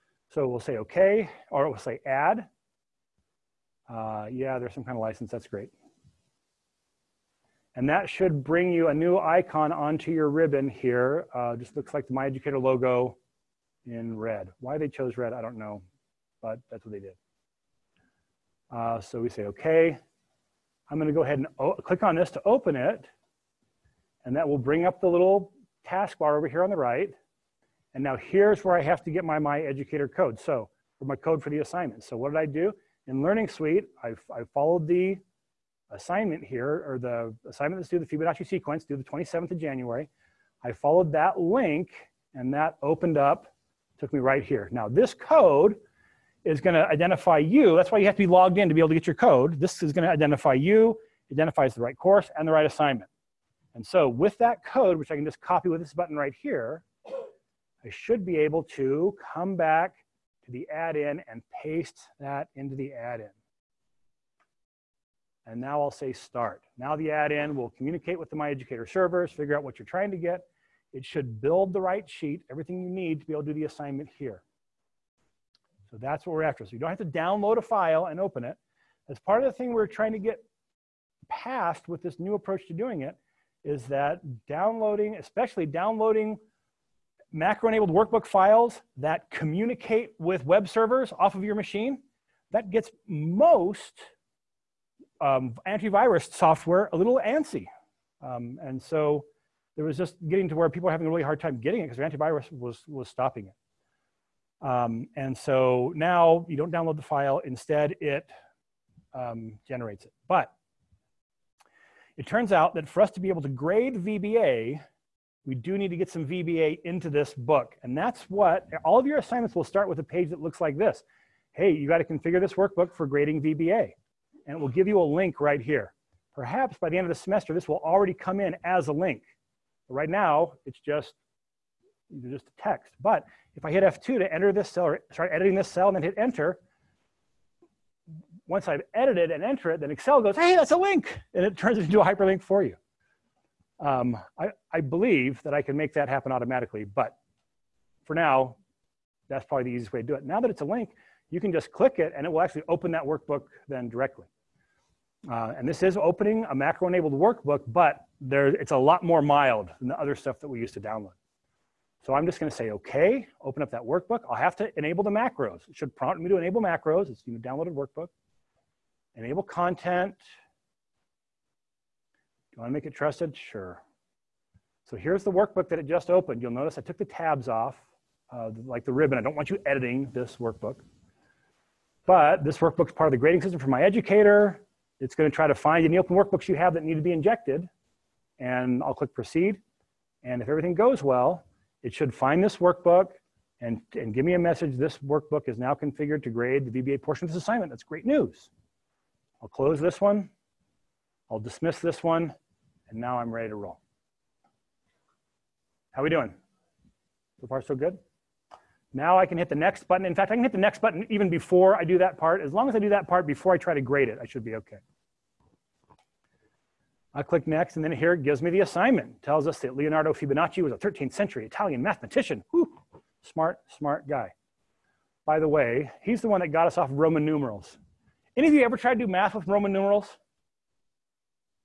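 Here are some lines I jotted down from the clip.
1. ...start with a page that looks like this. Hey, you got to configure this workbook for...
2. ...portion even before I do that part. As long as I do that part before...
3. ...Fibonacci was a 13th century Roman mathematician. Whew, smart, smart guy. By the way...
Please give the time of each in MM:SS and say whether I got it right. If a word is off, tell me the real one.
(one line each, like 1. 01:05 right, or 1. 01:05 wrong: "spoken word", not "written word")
1. 01:59 right
2. 03:30 wrong: "button", not "portion"
3. 03:40 wrong: "Italian", not "Roman".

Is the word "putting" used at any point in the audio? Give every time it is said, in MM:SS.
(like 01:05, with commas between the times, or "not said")
not said.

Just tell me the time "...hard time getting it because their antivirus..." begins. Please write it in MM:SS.
01:41.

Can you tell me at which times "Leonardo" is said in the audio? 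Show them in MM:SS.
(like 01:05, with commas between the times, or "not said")
03:39.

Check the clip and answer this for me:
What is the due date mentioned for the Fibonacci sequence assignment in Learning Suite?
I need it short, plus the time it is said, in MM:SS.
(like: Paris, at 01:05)
January 27, at 00:38.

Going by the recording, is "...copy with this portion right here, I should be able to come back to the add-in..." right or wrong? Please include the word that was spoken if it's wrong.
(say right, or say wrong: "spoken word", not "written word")
wrong: "button", not "portion".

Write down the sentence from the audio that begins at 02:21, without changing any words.
And it turns it into a hyperlink for you.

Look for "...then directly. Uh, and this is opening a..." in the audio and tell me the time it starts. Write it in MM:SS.
02:33.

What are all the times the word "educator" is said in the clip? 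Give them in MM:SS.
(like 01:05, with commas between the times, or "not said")
00:12, 00:29, 01:08, 03:03.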